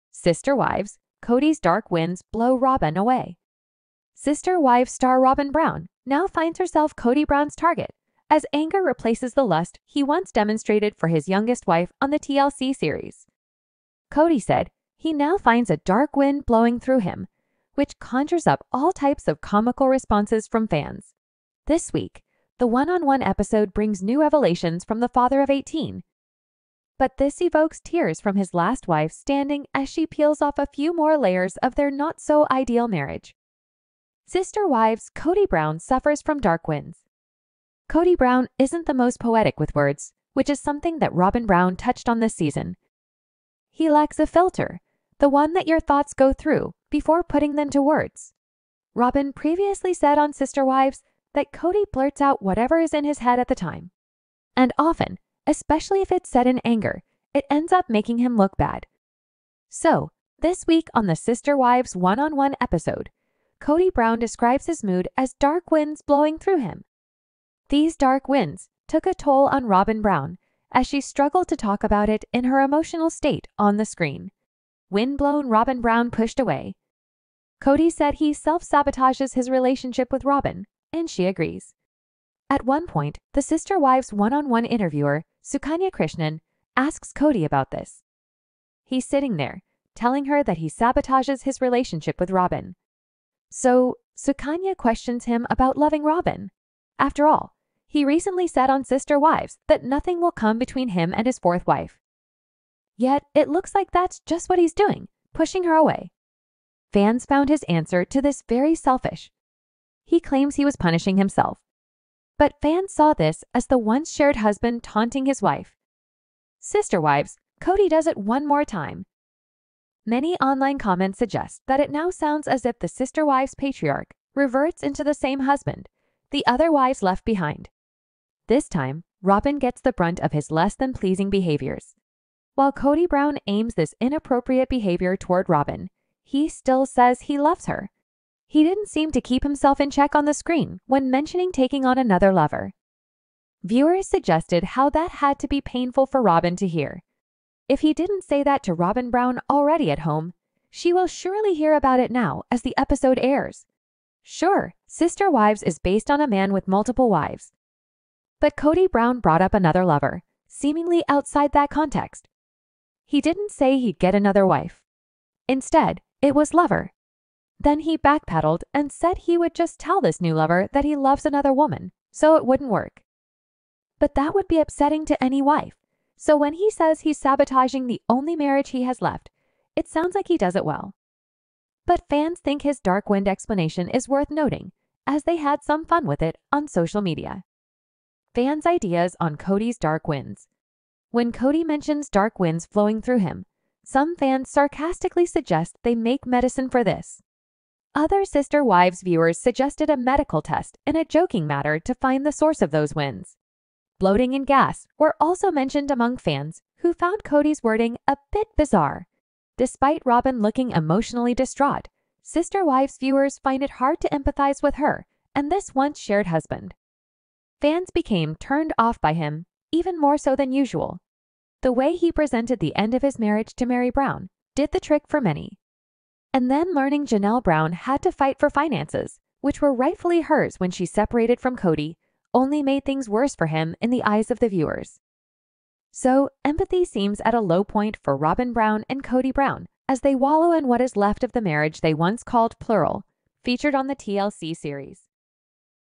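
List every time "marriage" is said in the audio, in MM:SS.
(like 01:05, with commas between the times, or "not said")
00:32, 02:58, 03:43, 04:01.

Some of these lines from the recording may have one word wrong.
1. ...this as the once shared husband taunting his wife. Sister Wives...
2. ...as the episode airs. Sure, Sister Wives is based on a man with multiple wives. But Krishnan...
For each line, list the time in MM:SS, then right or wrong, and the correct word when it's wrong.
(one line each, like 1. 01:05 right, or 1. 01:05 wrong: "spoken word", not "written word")
1. 01:53 right
2. 02:32 wrong: "Kody", not "Krishnan".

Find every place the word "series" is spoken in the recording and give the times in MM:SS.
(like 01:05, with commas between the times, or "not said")
00:12, 04:04.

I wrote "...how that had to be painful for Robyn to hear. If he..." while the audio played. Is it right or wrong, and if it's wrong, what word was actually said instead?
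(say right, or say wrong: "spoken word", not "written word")
right.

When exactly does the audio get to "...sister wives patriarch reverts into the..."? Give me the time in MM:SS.
02:02.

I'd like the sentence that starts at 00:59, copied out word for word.
So, this week on the Sister Wives one on one episode, Kody Brown describes his mood as dark winds blowing through him.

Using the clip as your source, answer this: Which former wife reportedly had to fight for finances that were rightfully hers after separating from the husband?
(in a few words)
Janelle Brown.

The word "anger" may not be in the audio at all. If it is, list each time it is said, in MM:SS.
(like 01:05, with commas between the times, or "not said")
00:08, 00:56.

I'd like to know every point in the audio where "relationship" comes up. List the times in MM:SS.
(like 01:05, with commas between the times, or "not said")
01:19, 01:31.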